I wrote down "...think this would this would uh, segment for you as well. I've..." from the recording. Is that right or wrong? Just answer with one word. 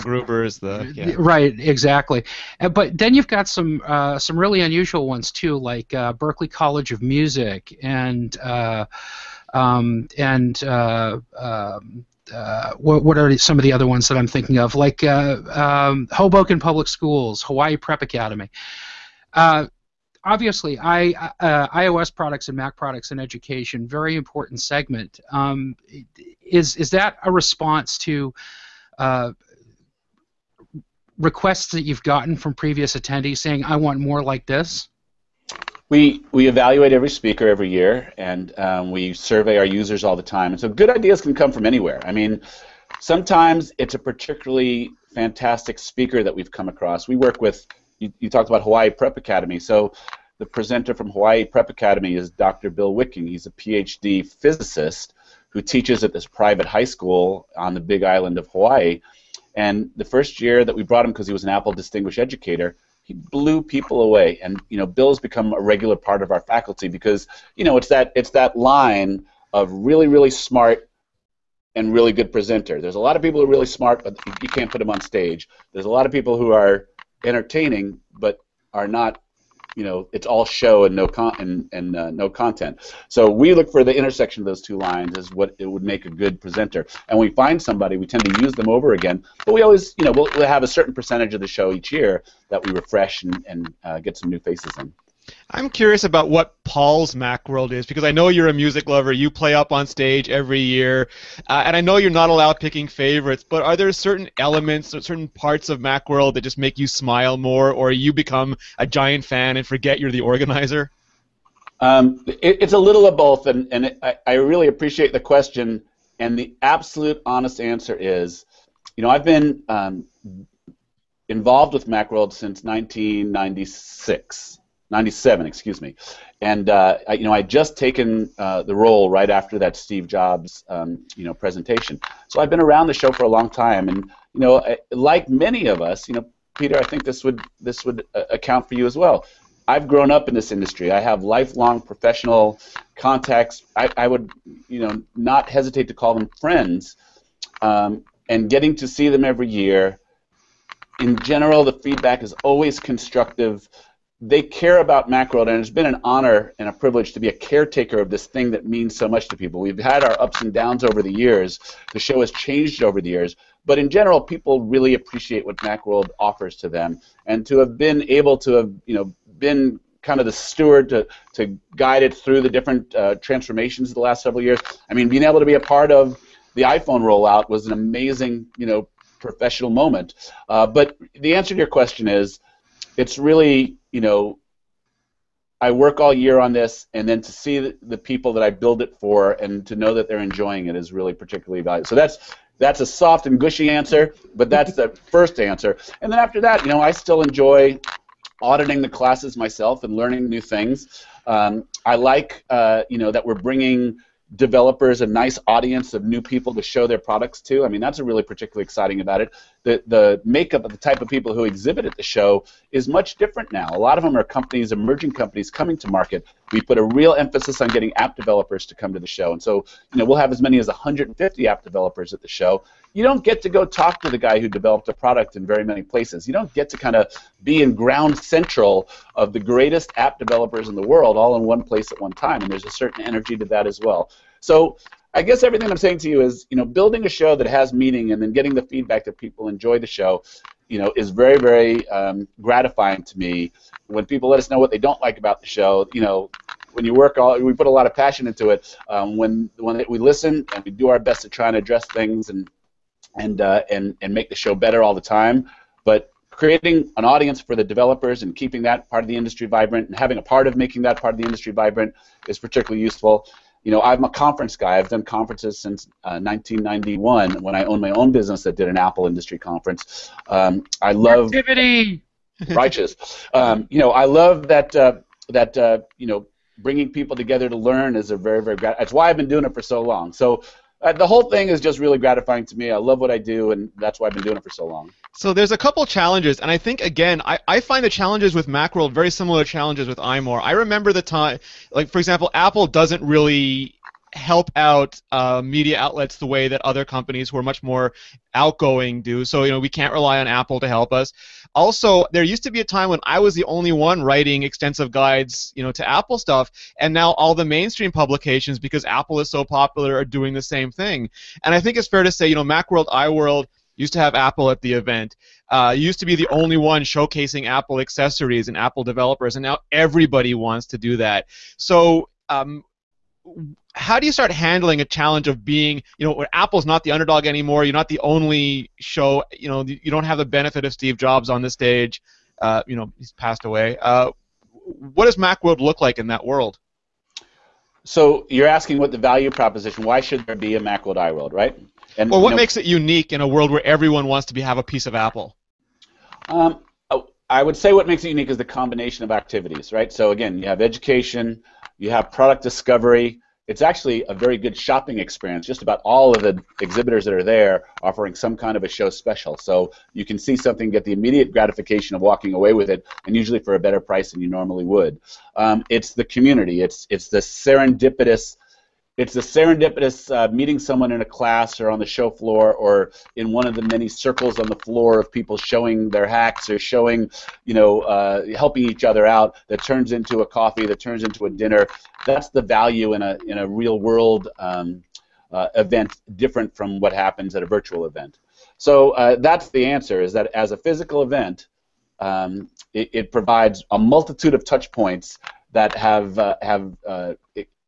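wrong.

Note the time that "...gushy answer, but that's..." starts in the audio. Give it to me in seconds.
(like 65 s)
193 s.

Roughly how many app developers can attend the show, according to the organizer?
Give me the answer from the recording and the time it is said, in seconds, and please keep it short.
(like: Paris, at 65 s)
150, at 220 s.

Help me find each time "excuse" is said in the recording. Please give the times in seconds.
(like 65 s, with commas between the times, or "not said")
125 s.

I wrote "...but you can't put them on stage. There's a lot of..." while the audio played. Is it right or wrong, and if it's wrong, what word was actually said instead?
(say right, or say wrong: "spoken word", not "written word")
right.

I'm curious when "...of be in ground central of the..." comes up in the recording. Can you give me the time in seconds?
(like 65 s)
226 s.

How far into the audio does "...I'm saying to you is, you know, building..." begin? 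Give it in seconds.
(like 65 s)
235 s.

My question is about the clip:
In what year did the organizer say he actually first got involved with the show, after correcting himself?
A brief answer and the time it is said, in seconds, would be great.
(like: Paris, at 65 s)
1997, at 124 s.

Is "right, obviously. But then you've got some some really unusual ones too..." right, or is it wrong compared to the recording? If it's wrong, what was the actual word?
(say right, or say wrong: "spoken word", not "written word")
wrong: "exactly", not "obviously".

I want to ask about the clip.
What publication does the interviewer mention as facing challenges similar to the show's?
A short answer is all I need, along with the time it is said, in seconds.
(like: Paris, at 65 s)
iMore, at 289 s.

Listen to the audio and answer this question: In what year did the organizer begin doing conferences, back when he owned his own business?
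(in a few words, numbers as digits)
1991.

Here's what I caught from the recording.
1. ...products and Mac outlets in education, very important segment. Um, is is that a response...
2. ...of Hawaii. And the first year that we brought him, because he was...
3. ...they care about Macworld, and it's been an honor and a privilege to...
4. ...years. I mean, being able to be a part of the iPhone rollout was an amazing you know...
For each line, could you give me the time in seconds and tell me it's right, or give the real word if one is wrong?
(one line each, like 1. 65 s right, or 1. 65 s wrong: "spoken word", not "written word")
1. 22 s wrong: "products", not "outlets"
2. 58 s right
3. 154 s right
4. 174 s right.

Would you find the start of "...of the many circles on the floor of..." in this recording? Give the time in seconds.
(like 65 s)
373 s.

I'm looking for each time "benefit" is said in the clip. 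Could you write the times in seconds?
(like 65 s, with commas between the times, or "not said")
330 s.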